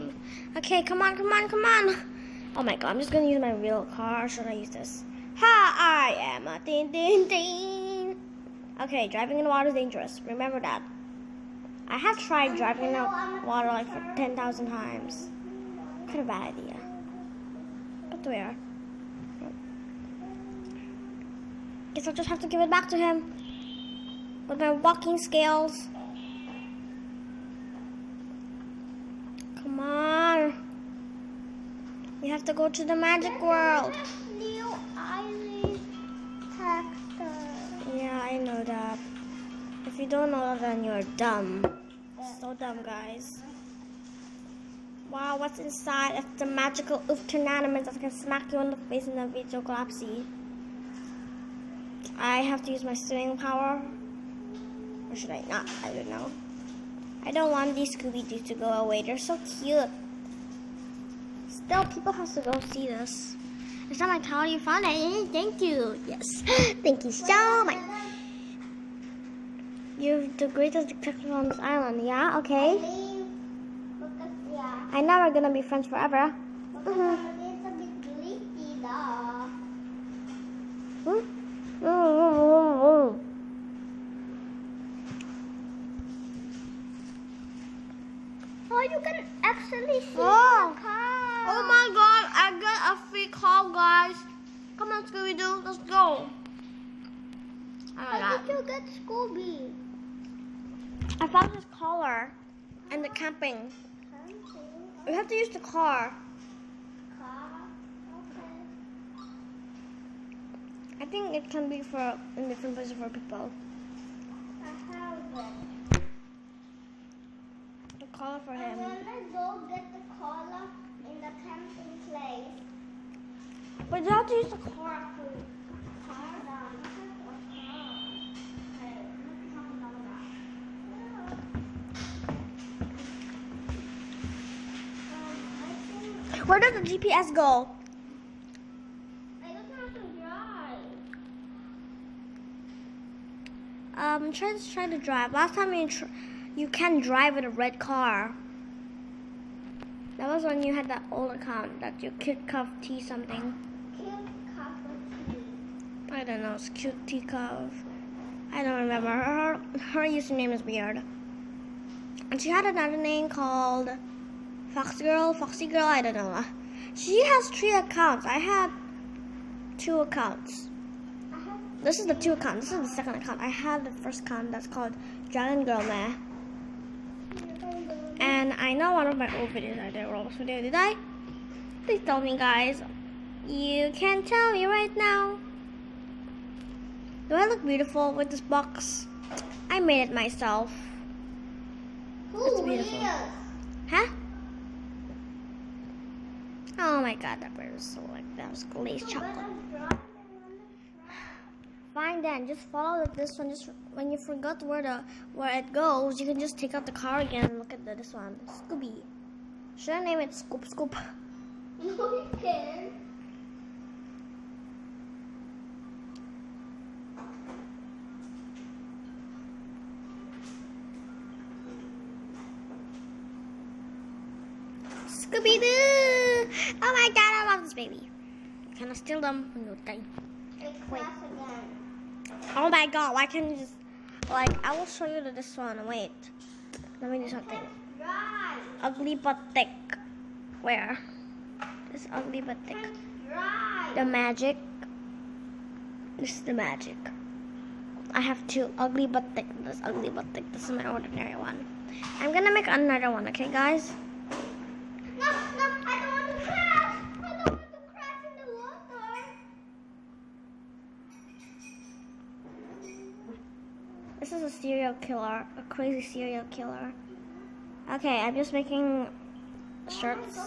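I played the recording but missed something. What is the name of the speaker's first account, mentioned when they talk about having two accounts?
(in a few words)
Dragon Girl Meh.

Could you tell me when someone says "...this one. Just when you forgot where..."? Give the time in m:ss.
3:23.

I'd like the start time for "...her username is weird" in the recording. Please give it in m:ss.
2:39.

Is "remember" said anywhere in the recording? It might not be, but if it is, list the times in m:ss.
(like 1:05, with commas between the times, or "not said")
0:10, 2:38.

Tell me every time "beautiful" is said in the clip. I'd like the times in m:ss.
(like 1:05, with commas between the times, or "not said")
3:07, 3:12.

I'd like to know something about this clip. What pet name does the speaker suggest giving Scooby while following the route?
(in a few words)
Scoop Scoop.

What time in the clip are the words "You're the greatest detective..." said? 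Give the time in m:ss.
1:09.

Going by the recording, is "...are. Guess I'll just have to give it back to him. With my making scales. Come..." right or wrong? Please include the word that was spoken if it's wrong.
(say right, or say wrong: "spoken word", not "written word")
wrong: "walking", not "making".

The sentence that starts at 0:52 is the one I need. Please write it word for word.
I have to use my swimming power.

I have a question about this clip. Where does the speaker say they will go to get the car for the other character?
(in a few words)
the camping place.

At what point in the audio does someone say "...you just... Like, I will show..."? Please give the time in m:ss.
3:53.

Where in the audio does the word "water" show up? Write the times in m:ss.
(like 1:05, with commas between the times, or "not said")
0:09, 0:13.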